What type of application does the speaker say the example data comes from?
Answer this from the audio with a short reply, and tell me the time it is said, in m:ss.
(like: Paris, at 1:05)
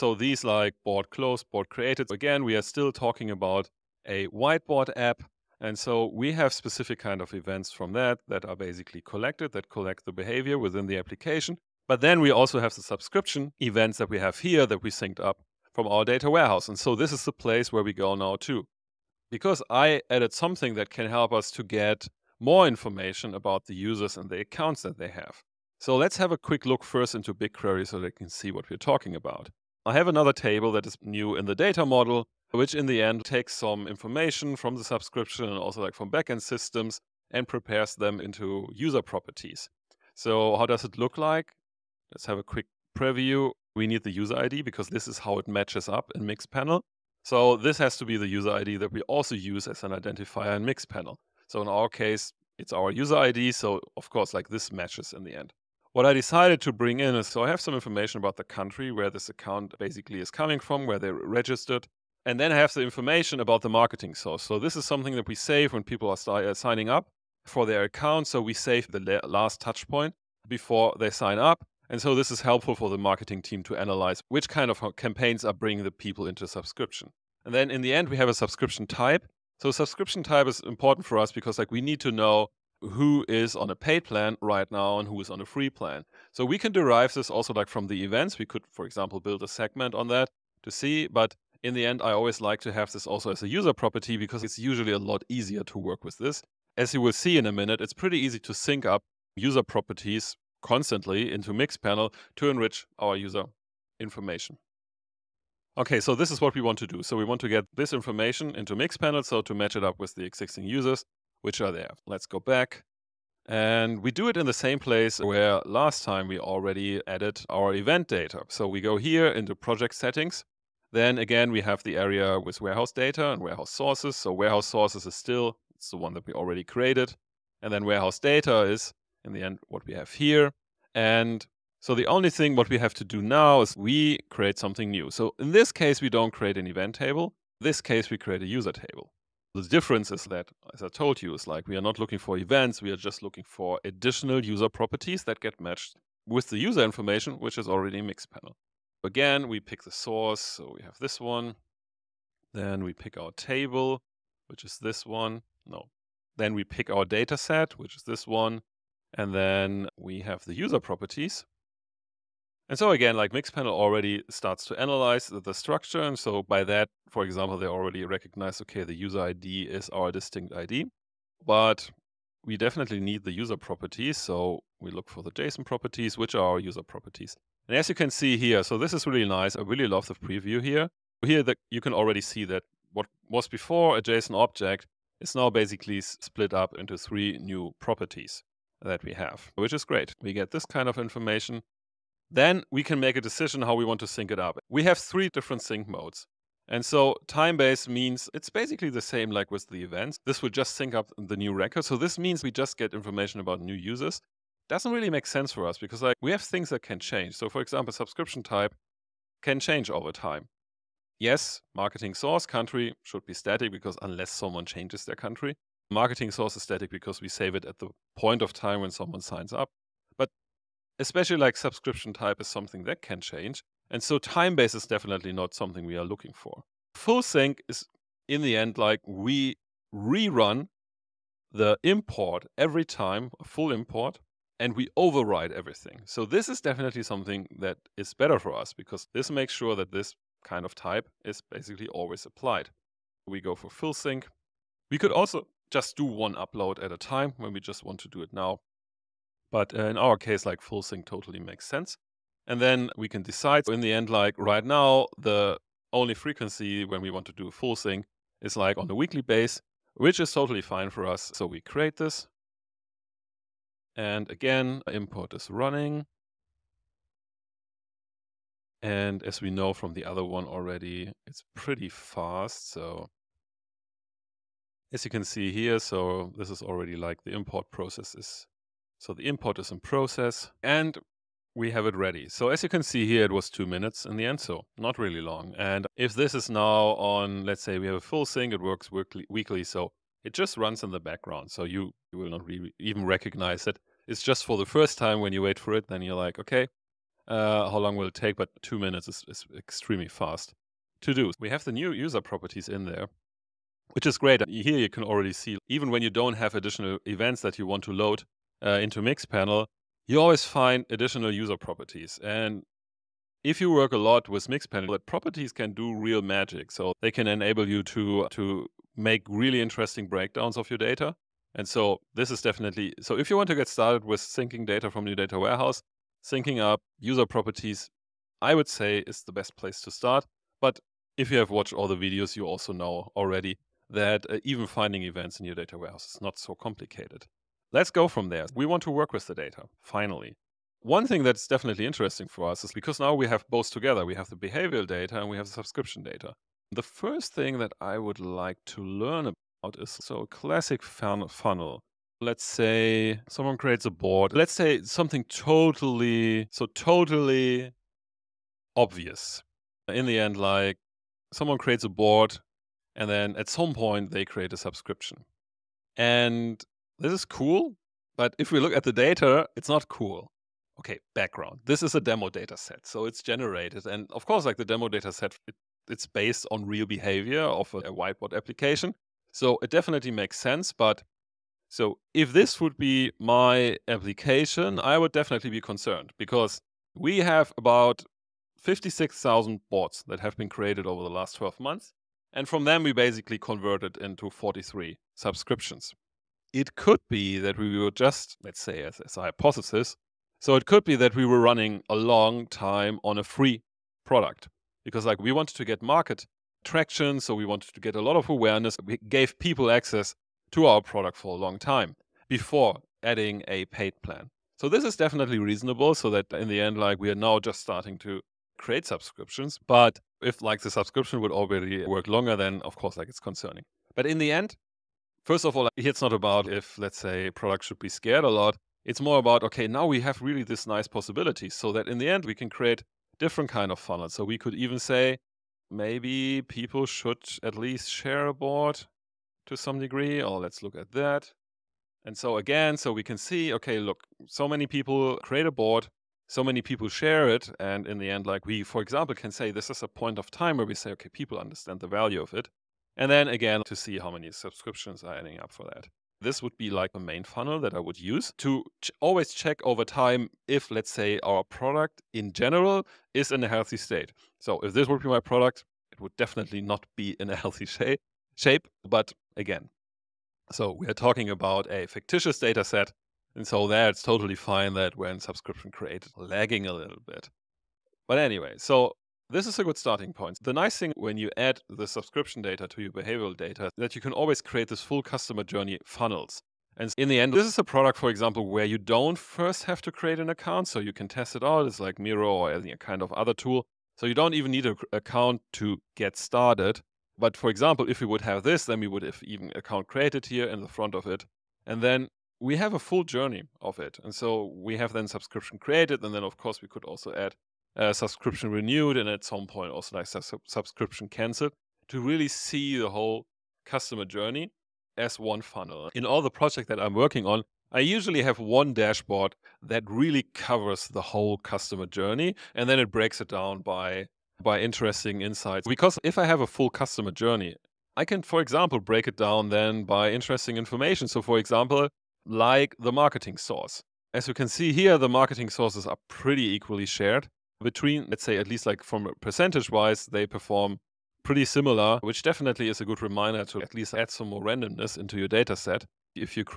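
Whiteboard app, at 0:04.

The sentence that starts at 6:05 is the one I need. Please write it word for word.
And this is cool, but if we look at the data, it's not cool.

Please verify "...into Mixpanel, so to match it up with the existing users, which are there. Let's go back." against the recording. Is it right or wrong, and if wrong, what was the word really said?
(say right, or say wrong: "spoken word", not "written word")
right.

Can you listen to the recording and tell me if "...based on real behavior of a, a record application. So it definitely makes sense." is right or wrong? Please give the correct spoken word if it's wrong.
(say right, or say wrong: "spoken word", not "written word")
wrong: "whiteboard", not "record".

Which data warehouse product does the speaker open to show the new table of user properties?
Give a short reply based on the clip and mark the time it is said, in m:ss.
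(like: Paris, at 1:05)
BigQuery, at 0:27.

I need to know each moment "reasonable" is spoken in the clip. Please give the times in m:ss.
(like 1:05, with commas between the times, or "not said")
6:55.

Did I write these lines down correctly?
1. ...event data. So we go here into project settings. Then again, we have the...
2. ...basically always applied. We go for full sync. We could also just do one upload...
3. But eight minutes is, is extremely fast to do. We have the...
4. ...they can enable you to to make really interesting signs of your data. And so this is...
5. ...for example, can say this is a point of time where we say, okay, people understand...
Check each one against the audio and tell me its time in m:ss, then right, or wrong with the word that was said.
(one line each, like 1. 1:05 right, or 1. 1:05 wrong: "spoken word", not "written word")
1. 1:57 right
2. 4:01 right
3. 4:58 wrong: "two", not "eight"
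4. 5:17 wrong: "breakdowns", not "signs"
5. 7:28 right.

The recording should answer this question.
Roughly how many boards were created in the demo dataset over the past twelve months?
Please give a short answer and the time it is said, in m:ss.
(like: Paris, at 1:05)
56,000, at 6:28.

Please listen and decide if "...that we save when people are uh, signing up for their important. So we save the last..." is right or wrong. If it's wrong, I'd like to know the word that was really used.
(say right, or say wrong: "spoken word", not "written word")
wrong: "account", not "important".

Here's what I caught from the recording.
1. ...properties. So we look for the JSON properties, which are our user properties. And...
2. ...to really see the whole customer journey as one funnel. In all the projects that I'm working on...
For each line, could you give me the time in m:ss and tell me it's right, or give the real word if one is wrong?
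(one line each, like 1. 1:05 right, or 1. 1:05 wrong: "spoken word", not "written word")
1. 2:53 right
2. 8:31 right.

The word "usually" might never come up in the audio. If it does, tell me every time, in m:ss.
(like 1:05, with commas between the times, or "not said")
1:34, 8:37.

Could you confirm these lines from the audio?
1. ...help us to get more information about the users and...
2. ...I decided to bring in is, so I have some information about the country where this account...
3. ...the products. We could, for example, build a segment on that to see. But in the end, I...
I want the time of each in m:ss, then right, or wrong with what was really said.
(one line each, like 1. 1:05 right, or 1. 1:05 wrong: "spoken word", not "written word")
1. 0:21 right
2. 0:56 right
3. 1:27 wrong: "events", not "products".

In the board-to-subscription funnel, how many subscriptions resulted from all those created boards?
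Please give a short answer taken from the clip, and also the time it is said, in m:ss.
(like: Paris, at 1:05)
43, at 6:34.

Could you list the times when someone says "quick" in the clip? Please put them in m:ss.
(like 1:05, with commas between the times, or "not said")
0:26, 0:42.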